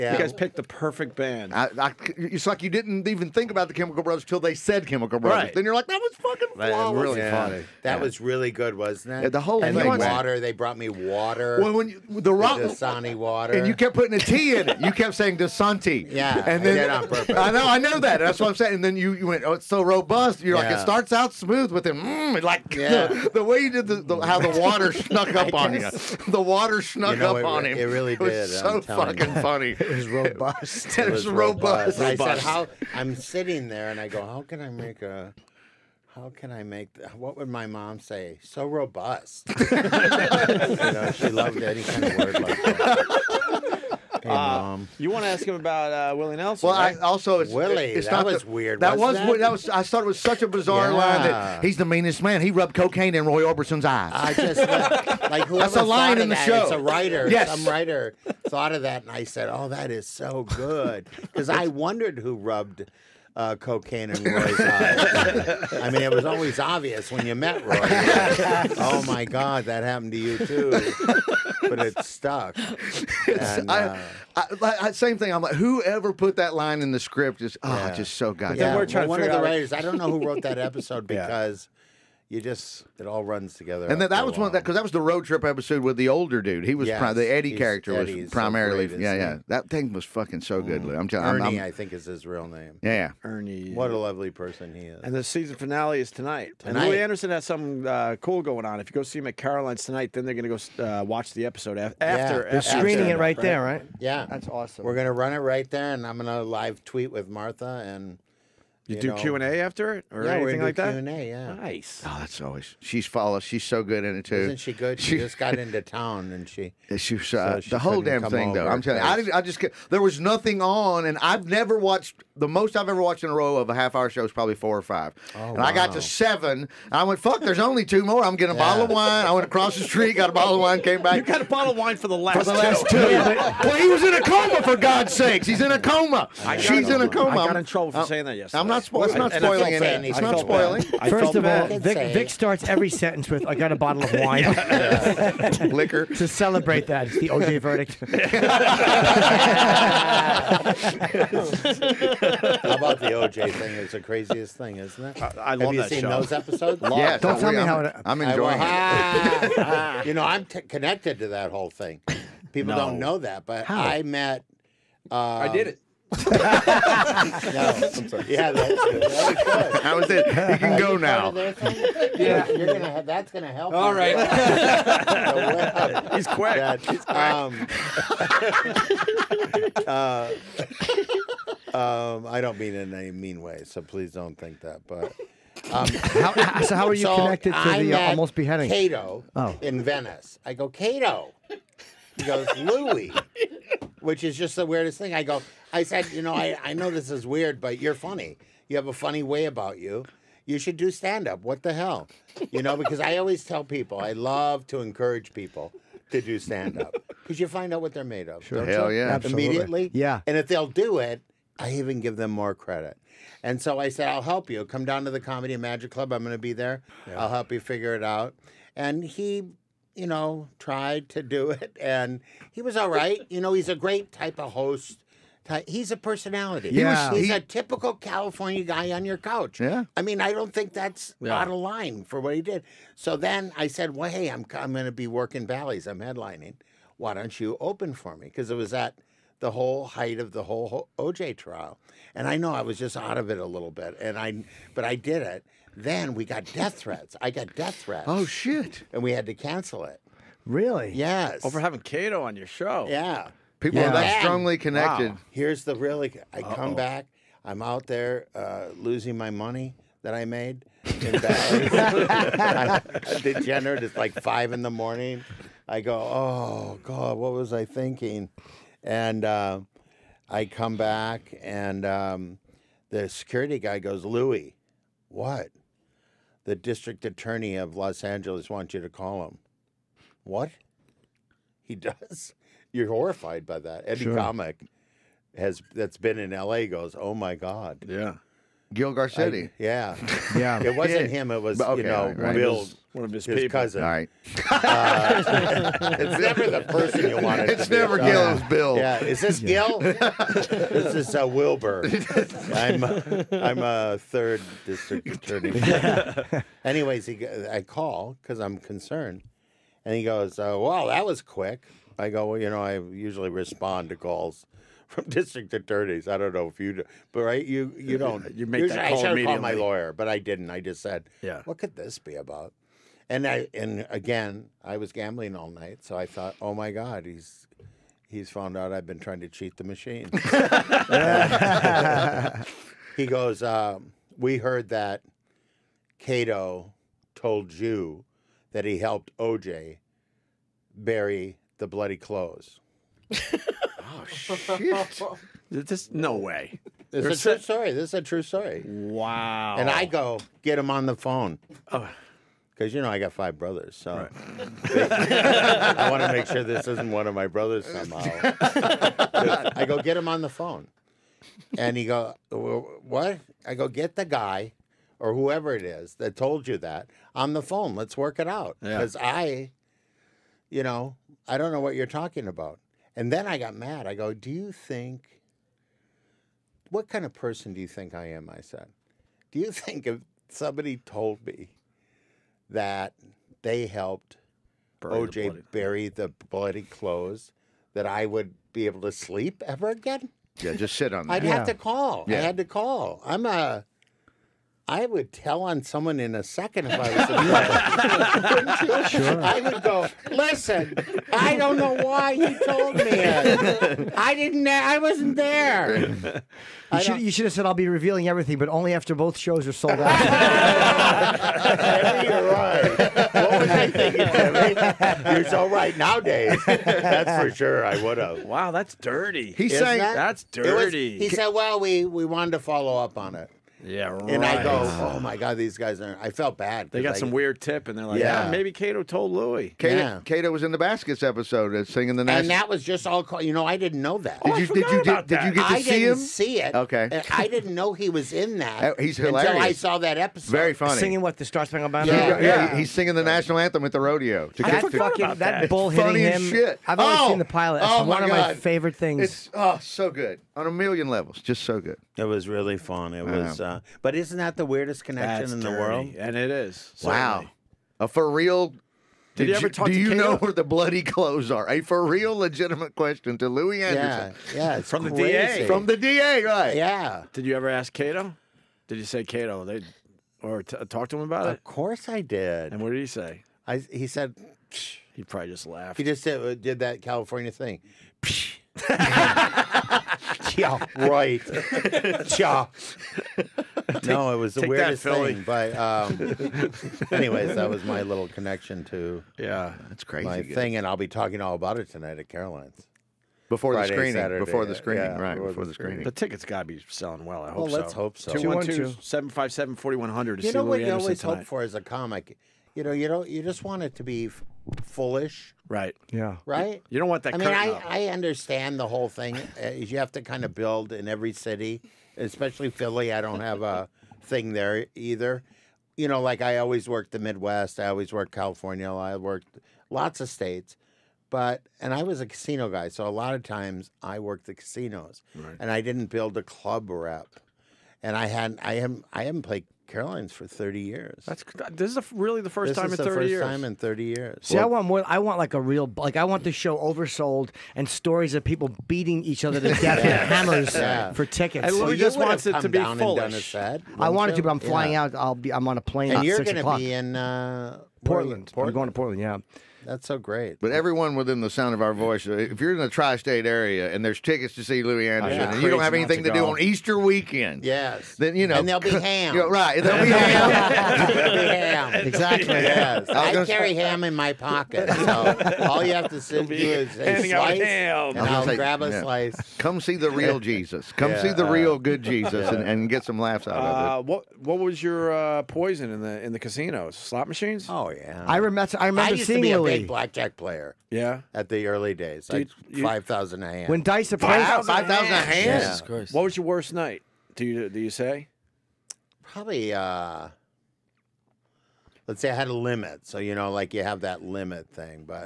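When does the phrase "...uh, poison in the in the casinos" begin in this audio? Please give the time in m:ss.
9:34.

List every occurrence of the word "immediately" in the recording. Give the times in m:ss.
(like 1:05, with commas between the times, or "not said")
3:29, 5:19.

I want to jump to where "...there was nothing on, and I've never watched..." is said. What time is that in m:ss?
1:59.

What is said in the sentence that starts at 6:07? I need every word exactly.
Let's work it out because yeah.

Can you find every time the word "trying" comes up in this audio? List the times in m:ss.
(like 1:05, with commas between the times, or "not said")
1:18, 5:28.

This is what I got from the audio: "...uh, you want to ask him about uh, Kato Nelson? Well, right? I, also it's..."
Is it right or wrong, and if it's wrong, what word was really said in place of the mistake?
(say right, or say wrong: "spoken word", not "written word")
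wrong: "Willie", not "Kato".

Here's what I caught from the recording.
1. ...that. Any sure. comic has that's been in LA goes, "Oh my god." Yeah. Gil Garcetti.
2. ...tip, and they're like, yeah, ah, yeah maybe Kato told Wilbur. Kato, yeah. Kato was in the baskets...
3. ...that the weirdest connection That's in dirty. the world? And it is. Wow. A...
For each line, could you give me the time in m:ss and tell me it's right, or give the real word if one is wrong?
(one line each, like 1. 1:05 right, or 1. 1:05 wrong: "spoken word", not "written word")
1. 4:43 right
2. 7:07 wrong: "Louie", not "Wilbur"
3. 7:34 right.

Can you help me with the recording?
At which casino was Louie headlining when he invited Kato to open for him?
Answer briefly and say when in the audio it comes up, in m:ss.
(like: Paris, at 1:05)
Bally's, at 3:55.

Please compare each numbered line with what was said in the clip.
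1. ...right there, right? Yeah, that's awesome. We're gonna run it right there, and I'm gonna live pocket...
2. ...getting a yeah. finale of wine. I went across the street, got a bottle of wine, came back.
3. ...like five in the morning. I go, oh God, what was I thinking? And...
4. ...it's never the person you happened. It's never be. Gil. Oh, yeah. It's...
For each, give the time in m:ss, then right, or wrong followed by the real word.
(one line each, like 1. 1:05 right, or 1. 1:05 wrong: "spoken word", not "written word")
1. 1:43 wrong: "tweet", not "pocket"
2. 2:08 wrong: "bottle", not "finale"
3. 4:23 right
4. 4:55 wrong: "wanted", not "happened".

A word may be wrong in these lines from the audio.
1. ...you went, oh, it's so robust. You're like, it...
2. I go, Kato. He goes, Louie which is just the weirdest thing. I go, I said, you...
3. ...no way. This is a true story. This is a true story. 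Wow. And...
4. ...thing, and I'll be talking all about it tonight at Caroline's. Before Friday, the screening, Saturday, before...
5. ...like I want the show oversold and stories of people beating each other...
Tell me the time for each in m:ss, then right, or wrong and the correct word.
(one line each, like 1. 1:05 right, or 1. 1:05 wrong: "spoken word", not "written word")
1. 0:19 right
2. 3:10 right
3. 5:45 right
4. 8:10 right
5. 8:55 right.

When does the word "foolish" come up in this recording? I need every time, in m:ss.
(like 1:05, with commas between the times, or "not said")
8:24, 9:02.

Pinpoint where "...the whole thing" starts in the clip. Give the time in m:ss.
8:28.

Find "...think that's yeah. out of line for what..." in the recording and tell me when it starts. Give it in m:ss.
3:50.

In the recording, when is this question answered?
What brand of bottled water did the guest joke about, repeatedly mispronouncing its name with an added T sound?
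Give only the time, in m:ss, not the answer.
0:12.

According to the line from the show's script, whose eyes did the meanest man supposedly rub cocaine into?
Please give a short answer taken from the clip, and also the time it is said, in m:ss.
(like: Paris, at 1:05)
Roy Orbison, at 0:53.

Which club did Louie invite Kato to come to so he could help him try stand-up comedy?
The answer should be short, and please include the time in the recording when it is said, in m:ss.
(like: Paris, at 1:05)
Comedy Magic Club, at 3:35.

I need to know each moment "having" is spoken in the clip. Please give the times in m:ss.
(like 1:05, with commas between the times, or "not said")
4:11.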